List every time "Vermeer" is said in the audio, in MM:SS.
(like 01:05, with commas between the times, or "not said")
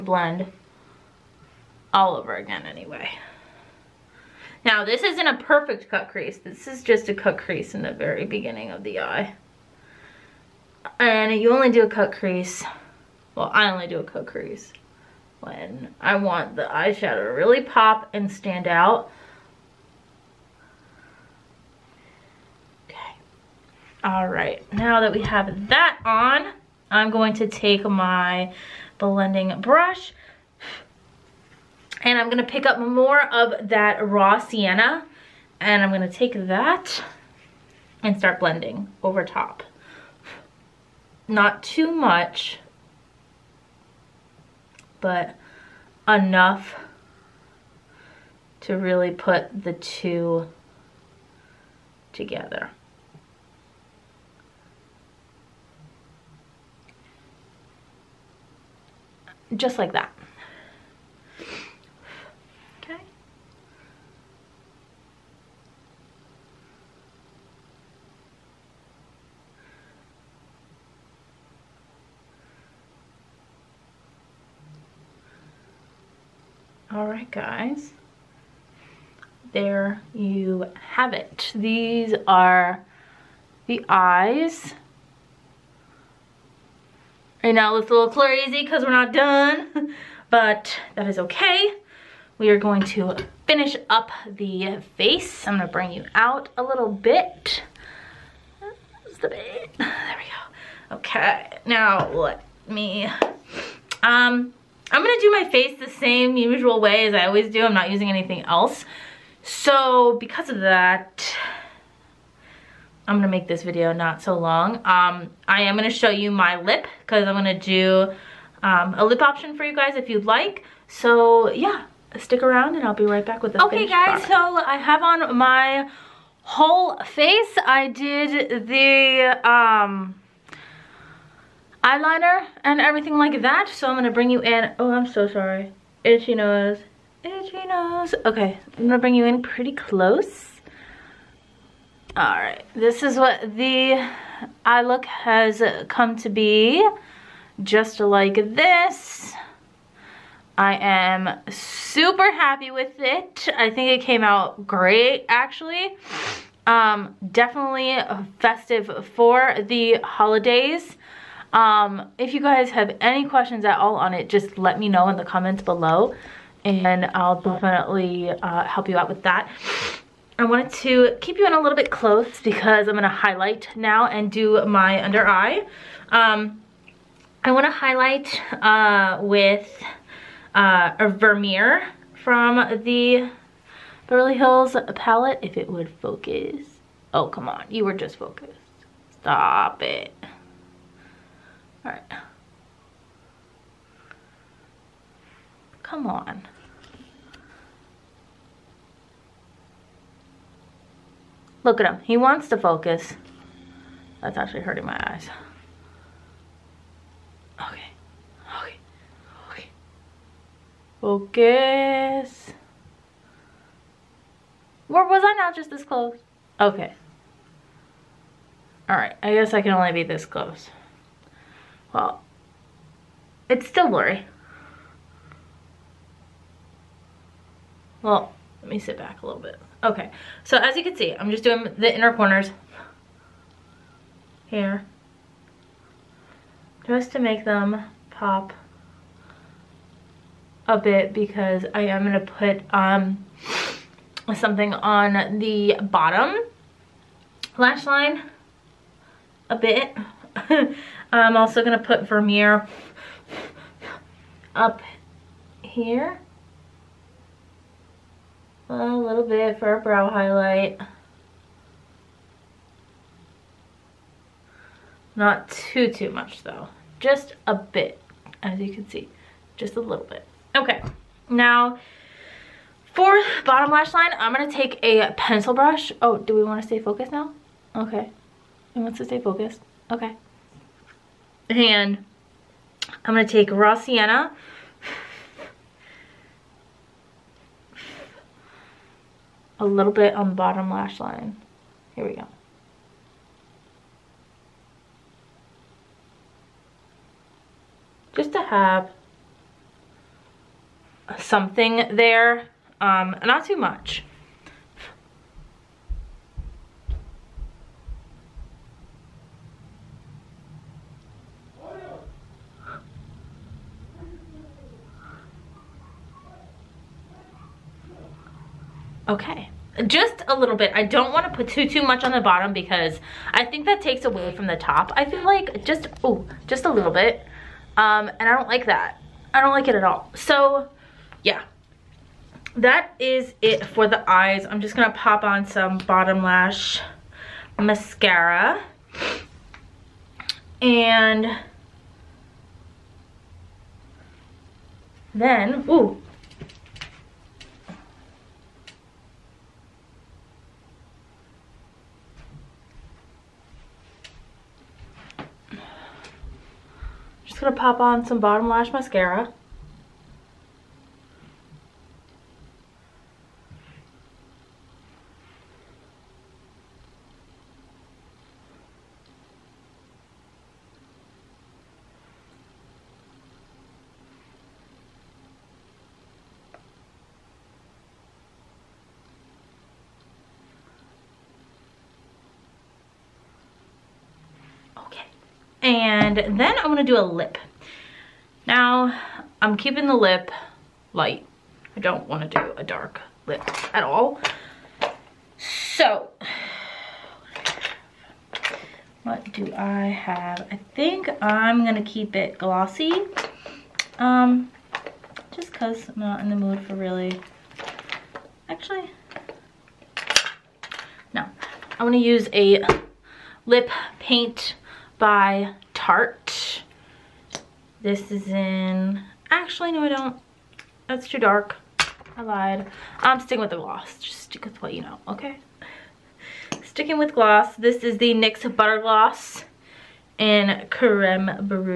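03:01, 04:12.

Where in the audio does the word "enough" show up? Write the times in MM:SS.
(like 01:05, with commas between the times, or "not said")
00:46.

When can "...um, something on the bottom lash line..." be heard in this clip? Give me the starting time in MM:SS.
04:02.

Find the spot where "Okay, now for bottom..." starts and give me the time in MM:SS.
04:30.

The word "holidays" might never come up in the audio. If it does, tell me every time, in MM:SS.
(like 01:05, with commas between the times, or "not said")
02:40.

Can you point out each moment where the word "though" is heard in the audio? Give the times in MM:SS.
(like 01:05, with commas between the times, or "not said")
04:26.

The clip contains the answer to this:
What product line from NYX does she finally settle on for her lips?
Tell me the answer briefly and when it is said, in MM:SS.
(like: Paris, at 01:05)
Butter Gloss, at 07:08.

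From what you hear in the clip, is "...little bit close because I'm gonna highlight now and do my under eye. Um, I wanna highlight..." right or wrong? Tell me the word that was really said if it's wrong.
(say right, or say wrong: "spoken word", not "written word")
right.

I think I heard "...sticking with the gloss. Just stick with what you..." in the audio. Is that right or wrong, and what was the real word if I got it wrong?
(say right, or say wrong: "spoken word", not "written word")
right.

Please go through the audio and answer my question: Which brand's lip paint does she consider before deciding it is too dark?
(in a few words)
Tarte.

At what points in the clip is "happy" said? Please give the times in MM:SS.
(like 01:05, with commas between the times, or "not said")
02:32.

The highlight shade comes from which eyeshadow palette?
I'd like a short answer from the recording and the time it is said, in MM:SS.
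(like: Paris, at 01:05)
Beverly Hills palette, at 03:04.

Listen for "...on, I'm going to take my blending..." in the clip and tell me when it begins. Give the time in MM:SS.
00:26.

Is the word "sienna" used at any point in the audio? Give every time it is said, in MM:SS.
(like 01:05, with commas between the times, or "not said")
00:34, 04:43.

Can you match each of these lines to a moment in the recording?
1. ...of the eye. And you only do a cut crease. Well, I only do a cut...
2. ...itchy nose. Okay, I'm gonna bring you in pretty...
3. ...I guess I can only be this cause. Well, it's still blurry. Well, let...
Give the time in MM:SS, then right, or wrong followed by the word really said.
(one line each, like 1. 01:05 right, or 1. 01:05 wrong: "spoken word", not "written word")
1. 00:08 right
2. 02:17 right
3. 03:39 wrong: "close", not "cause".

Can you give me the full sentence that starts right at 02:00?
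So yeah, stick around and I'll be right back with the Okay guys, product.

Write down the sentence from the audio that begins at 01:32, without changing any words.
We are going to finish up the face.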